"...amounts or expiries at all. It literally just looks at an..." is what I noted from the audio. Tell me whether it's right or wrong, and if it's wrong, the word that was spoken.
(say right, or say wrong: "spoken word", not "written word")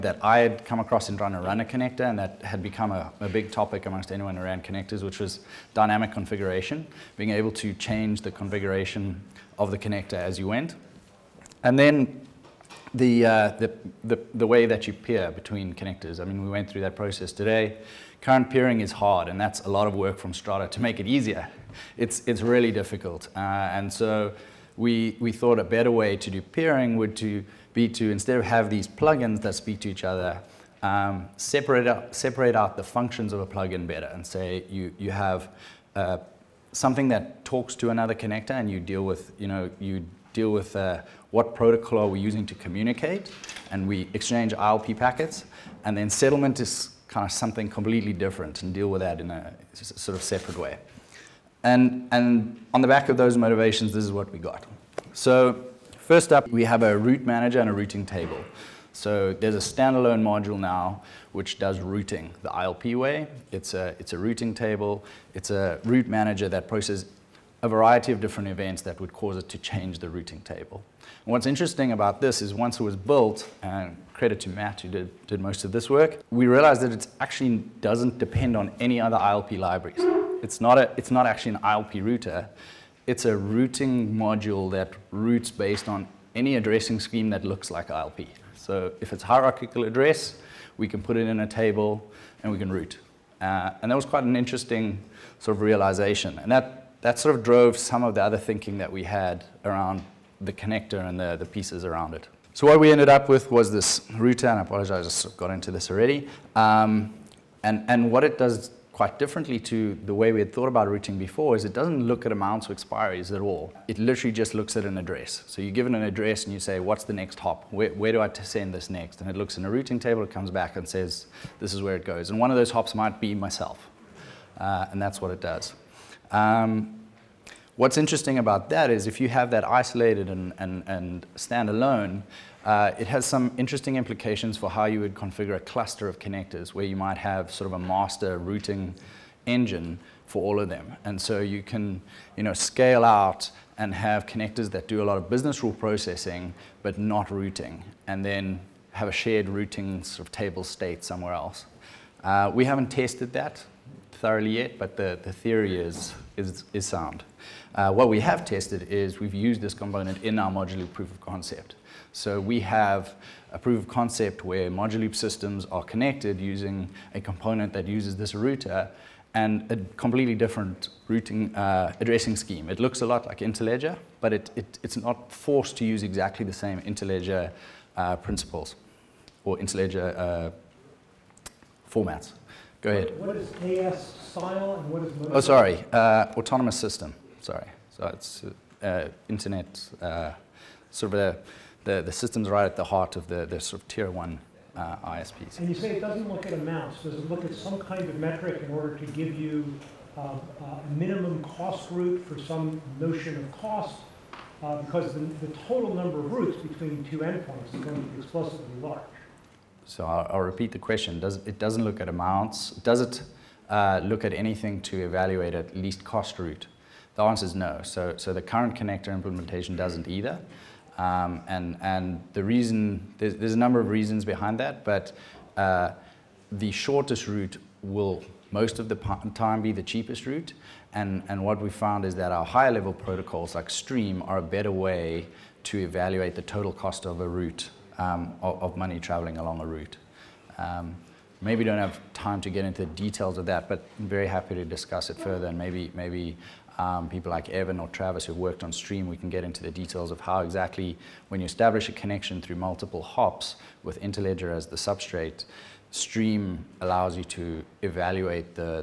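right.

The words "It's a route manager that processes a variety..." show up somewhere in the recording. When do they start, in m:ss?
1:05.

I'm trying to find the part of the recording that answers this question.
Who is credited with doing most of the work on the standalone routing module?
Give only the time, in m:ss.
1:14.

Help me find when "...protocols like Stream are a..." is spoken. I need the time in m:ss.
3:52.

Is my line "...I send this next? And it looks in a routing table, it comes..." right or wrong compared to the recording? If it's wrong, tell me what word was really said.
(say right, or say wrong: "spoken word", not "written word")
right.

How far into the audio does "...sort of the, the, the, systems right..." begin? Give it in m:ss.
3:10.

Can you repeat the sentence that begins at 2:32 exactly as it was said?
Uh, we haven't tested that thoroughly yet, but the, the theory is, is, is sound.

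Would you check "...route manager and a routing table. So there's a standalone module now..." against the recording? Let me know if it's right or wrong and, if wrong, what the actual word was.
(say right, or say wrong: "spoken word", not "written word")
right.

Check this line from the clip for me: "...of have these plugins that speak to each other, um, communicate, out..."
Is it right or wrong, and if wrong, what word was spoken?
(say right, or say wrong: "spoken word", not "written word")
wrong: "separate", not "communicate".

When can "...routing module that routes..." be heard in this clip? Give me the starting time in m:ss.
1:23.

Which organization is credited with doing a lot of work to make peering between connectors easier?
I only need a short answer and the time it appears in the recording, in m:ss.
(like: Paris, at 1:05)
Strata, at 0:20.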